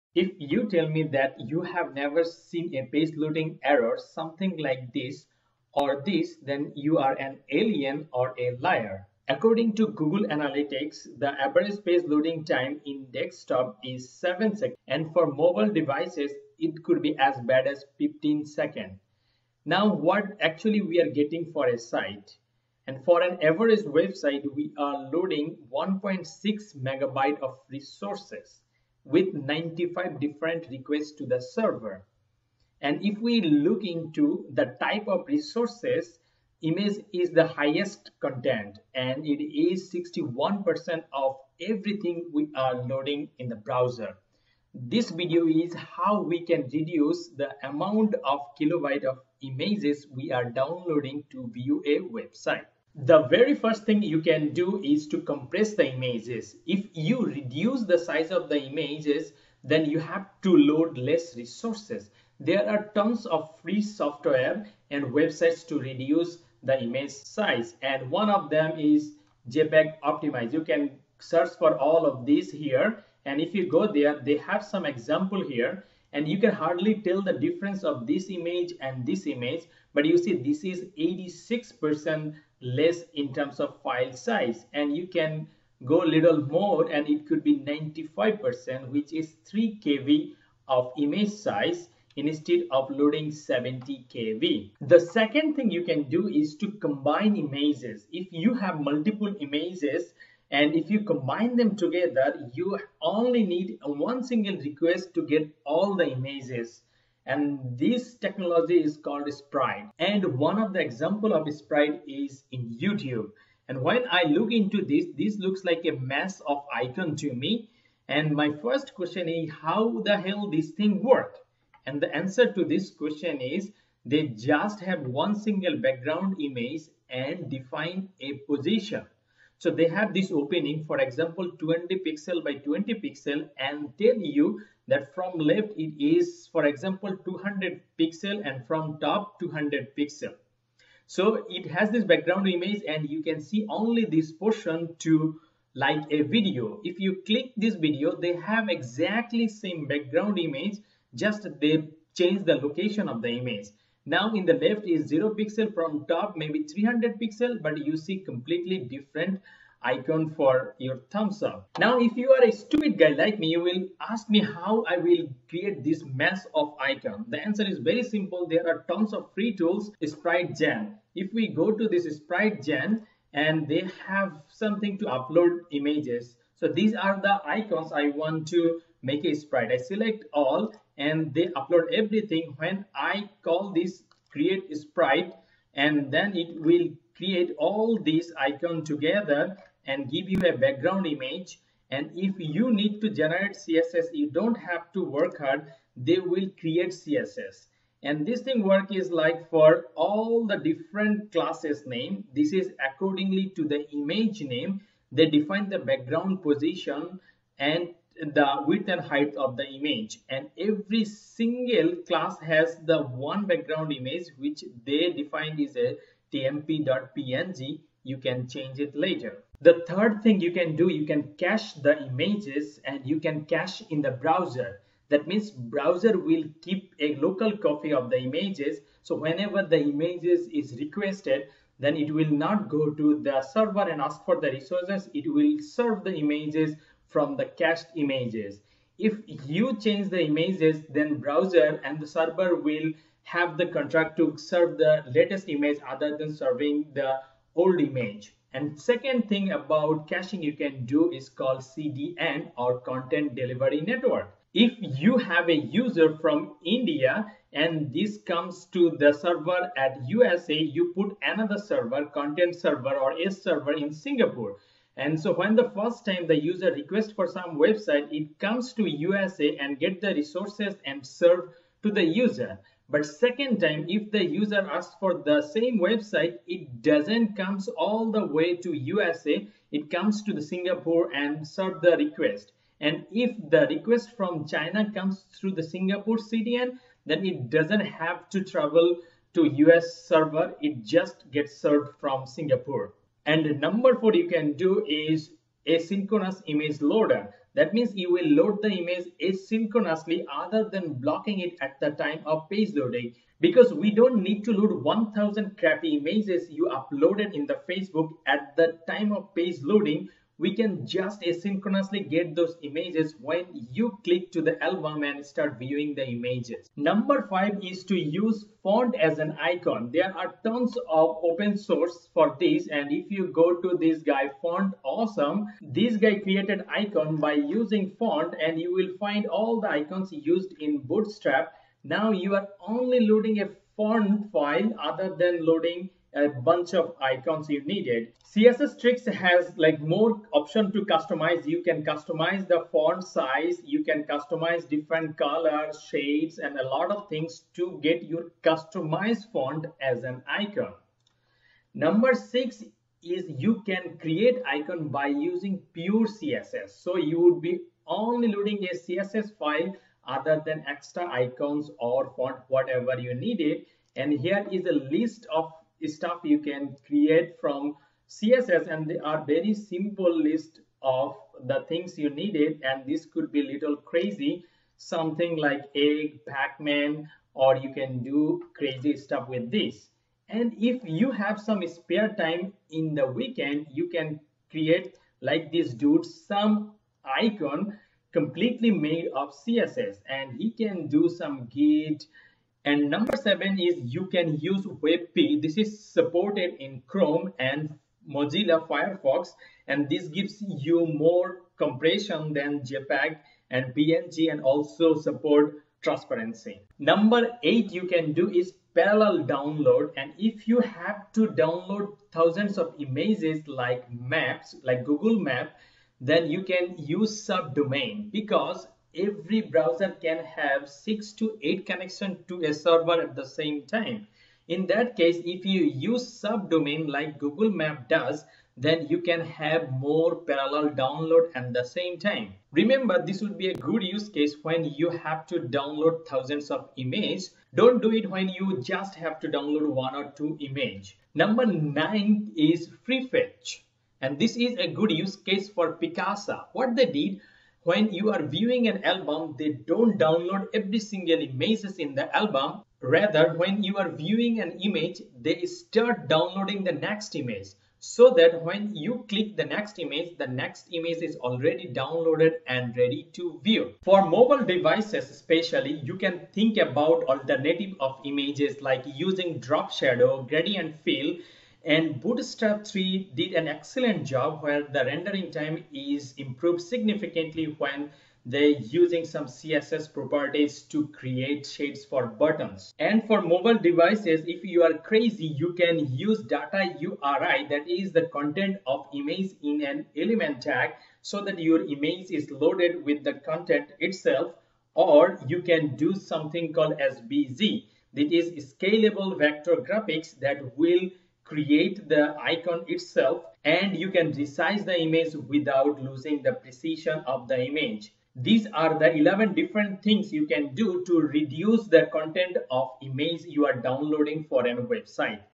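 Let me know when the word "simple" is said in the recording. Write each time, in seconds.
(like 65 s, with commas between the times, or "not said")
168 s, 369 s.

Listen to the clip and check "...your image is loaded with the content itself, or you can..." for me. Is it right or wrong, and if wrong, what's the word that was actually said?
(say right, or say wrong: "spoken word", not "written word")
right.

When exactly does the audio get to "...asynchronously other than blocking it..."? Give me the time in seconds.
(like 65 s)
299 s.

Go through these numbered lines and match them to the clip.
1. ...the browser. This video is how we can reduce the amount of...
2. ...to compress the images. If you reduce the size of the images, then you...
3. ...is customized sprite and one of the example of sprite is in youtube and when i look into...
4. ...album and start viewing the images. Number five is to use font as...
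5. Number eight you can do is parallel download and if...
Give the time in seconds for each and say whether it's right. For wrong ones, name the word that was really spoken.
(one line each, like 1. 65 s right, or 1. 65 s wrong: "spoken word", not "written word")
1. 43 s right
2. 55 s right
3. 108 s wrong: "called", not "customized"
4. 314 s right
5. 406 s right.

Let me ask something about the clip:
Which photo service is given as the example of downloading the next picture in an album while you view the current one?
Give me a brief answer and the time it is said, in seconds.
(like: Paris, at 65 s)
Picasa, at 445 s.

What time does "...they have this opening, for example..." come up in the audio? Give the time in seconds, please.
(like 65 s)
129 s.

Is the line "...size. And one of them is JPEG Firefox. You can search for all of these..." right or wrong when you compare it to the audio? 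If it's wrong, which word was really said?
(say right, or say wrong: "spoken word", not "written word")
wrong: "Optimize", not "Firefox".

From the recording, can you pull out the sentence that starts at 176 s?
So these are the icons I want to make a sprite.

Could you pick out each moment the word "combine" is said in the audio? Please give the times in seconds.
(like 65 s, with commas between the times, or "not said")
96 s, 101 s.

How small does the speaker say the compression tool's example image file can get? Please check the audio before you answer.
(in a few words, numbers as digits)
3 kb.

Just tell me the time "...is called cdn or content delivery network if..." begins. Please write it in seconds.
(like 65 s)
251 s.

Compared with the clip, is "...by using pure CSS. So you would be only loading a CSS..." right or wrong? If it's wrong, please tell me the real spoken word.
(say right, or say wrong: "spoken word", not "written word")
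right.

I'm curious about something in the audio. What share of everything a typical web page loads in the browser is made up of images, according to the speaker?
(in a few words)
61%.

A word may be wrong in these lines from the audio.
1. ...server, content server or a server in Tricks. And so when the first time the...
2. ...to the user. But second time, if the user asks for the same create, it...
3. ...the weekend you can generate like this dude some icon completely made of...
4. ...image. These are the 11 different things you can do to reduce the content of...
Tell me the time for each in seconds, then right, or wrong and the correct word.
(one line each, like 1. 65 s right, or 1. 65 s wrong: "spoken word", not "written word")
1. 261 s wrong: "Singapore", not "Tricks"
2. 271 s wrong: "website", not "create"
3. 382 s wrong: "create", not "generate"
4. 507 s right.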